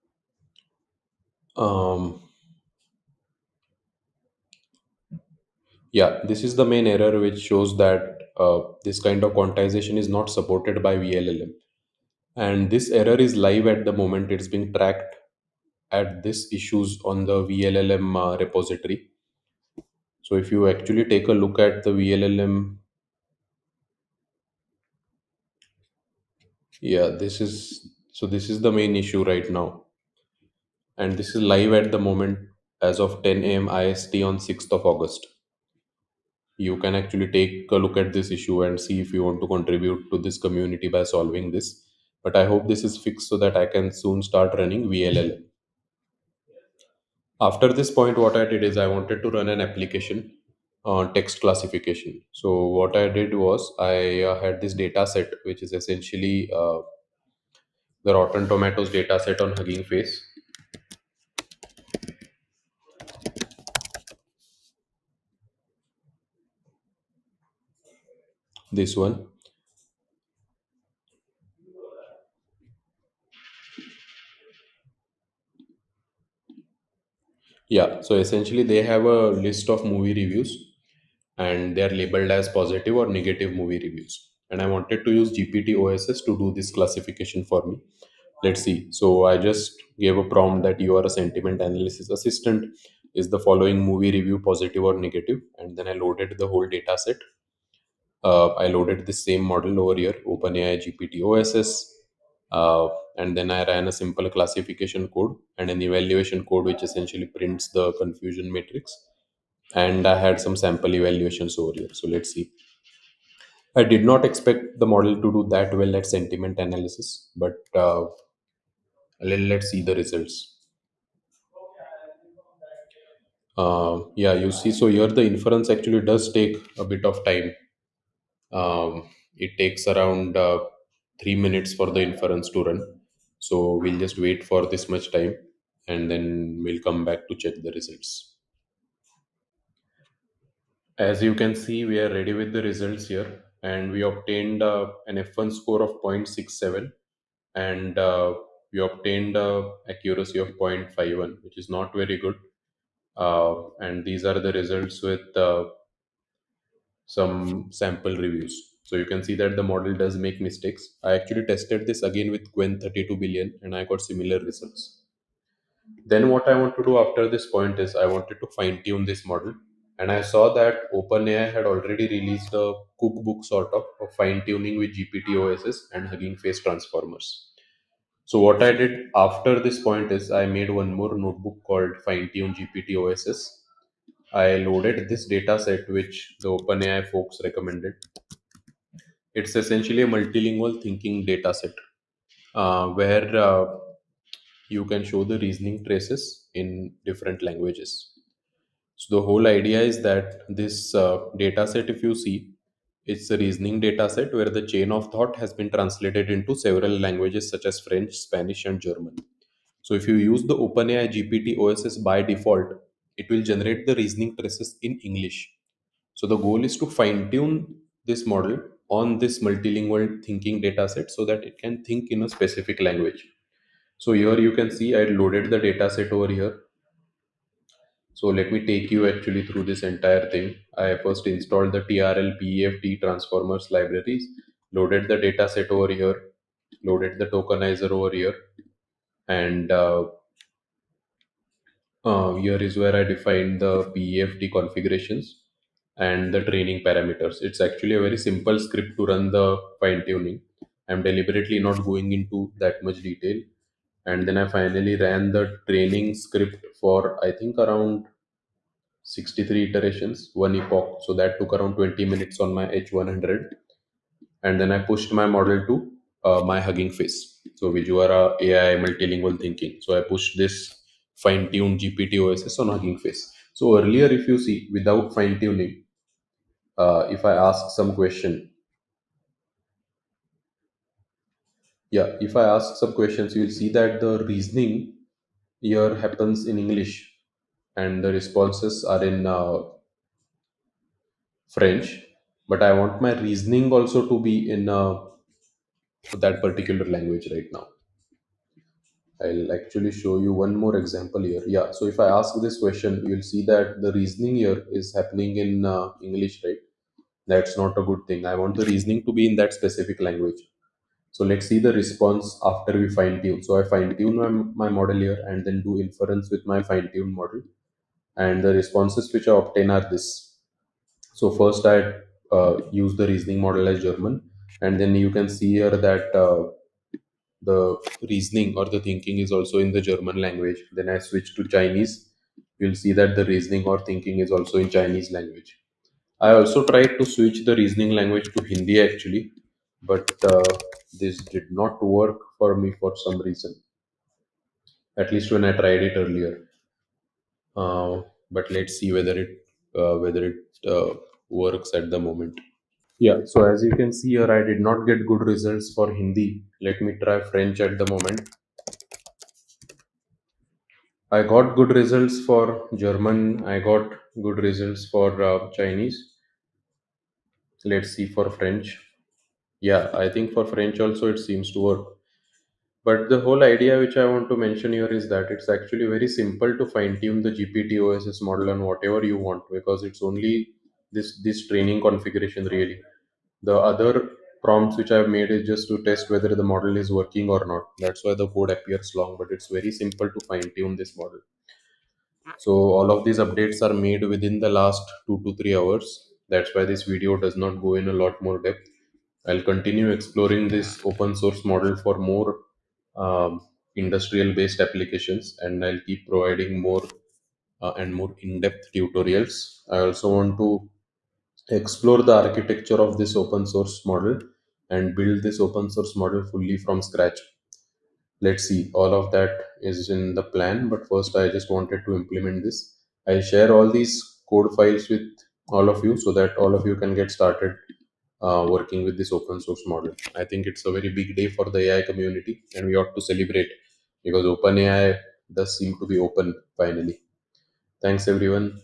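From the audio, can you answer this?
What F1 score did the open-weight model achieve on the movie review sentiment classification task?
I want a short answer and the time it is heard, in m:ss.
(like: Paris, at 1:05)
0.67, at 2:26.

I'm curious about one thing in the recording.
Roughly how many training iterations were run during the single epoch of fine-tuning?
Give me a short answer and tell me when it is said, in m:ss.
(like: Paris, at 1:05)
63, at 4:19.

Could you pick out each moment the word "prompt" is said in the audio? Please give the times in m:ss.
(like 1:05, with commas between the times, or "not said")
1:30, 6:24.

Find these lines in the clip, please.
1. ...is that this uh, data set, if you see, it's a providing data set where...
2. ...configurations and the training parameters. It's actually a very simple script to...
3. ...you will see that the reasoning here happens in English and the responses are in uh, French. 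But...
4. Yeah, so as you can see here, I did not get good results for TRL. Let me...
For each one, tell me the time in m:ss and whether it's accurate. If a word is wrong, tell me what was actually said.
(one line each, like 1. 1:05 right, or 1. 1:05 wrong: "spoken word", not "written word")
1. 3:19 wrong: "reasoning", not "providing"
2. 4:04 right
3. 4:43 right
4. 5:52 wrong: "Hindi", not "TRL".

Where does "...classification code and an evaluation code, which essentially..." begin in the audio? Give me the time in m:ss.
1:44.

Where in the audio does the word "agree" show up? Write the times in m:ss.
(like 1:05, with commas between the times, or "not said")
not said.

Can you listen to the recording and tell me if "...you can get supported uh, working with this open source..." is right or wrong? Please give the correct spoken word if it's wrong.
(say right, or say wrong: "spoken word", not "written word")
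wrong: "started", not "supported".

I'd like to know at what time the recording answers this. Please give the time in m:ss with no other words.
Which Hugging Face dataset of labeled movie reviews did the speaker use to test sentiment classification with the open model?
0:58.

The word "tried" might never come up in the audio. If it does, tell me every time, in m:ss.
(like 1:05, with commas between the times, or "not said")
5:36, 5:45.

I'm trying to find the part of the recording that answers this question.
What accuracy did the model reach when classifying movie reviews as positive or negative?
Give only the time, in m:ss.
2:30.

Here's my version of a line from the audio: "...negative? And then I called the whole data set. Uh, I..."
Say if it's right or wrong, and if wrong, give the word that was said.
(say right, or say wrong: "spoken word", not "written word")
wrong: "loaded", not "called".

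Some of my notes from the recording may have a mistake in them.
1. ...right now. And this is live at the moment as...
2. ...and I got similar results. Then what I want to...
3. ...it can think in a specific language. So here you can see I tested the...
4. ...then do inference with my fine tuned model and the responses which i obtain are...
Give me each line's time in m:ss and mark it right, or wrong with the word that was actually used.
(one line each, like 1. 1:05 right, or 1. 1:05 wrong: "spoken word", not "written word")
1. 0:29 right
2. 2:43 right
3. 3:41 wrong: "loaded", not "tested"
4. 5:15 right.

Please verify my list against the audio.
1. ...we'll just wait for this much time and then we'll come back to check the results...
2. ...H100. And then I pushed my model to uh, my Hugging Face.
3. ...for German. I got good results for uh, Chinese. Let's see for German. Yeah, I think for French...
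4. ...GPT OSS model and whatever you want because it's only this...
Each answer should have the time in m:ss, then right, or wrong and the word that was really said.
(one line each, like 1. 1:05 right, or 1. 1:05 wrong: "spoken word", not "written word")
1. 2:13 right
2. 4:22 right
3. 6:02 wrong: "French", not "German"
4. 6:17 right.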